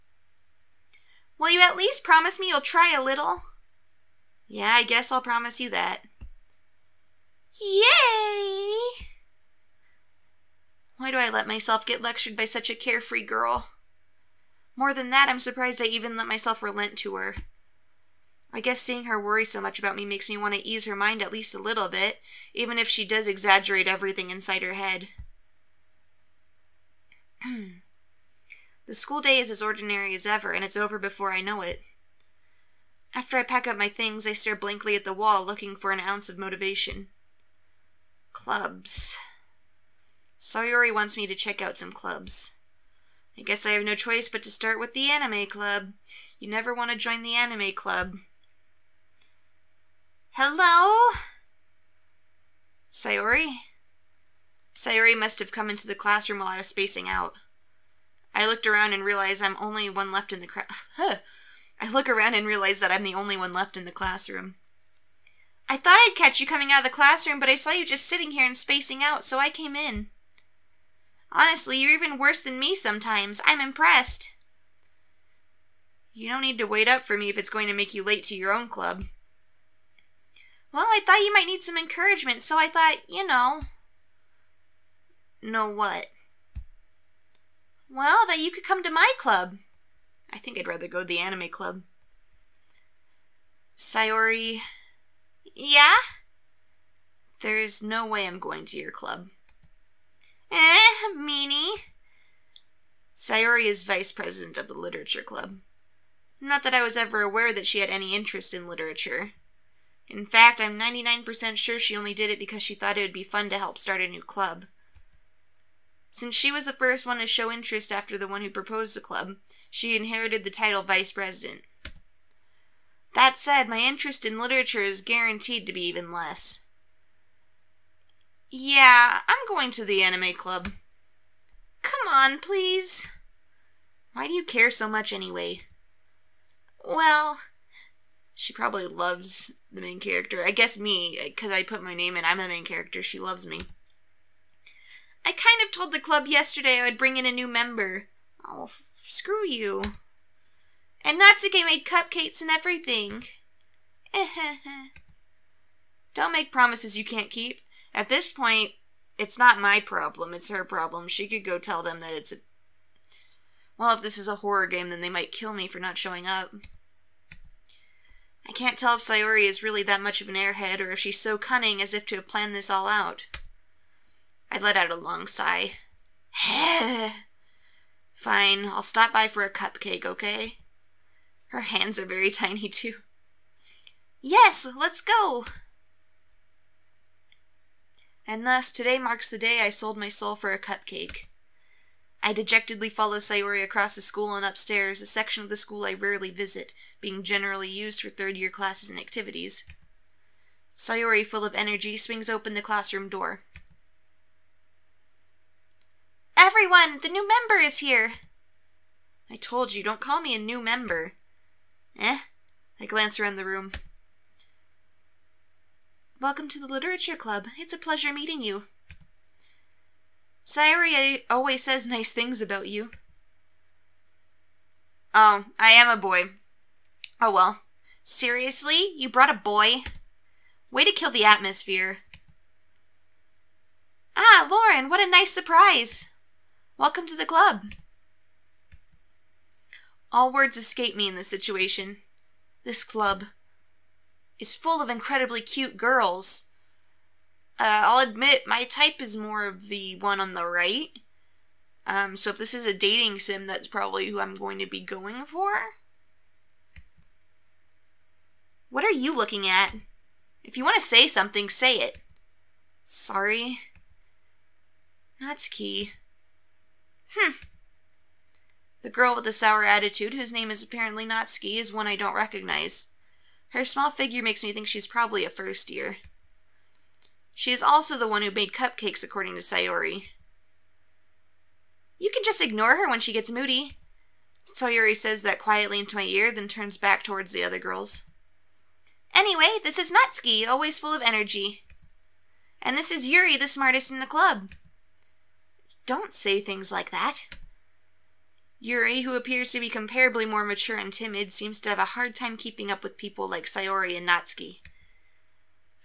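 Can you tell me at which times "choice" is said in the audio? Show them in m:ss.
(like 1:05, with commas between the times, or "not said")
0:43.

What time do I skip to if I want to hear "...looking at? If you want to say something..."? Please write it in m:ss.
4:19.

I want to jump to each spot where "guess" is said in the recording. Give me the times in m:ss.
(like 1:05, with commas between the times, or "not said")
0:04, 0:18, 0:43, 2:20.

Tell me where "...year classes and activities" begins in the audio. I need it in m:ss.
3:18.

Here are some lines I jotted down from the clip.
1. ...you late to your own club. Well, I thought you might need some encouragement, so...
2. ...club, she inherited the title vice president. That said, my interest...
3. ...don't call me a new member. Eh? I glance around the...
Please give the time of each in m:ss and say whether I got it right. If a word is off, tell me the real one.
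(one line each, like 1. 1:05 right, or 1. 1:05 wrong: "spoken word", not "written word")
1. 1:17 right
2. 1:58 right
3. 3:29 right.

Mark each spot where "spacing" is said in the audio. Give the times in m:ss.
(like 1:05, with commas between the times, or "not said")
0:56, 1:08.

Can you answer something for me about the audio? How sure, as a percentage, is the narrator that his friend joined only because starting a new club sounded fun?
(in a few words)
99%.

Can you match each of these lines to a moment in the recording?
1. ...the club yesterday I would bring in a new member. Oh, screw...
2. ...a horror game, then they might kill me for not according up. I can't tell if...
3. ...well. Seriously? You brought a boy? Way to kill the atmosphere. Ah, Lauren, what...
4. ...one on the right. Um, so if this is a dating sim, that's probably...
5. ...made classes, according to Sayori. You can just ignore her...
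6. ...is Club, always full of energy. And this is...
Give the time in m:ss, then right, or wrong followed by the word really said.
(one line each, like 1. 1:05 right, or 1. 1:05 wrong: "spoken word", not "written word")
1. 2:25 right
2. 2:44 wrong: "showing", not "according"
3. 3:47 right
4. 4:09 right
5. 4:38 wrong: "cupcakes", not "classes"
6. 4:49 wrong: "Natsuki", not "Club".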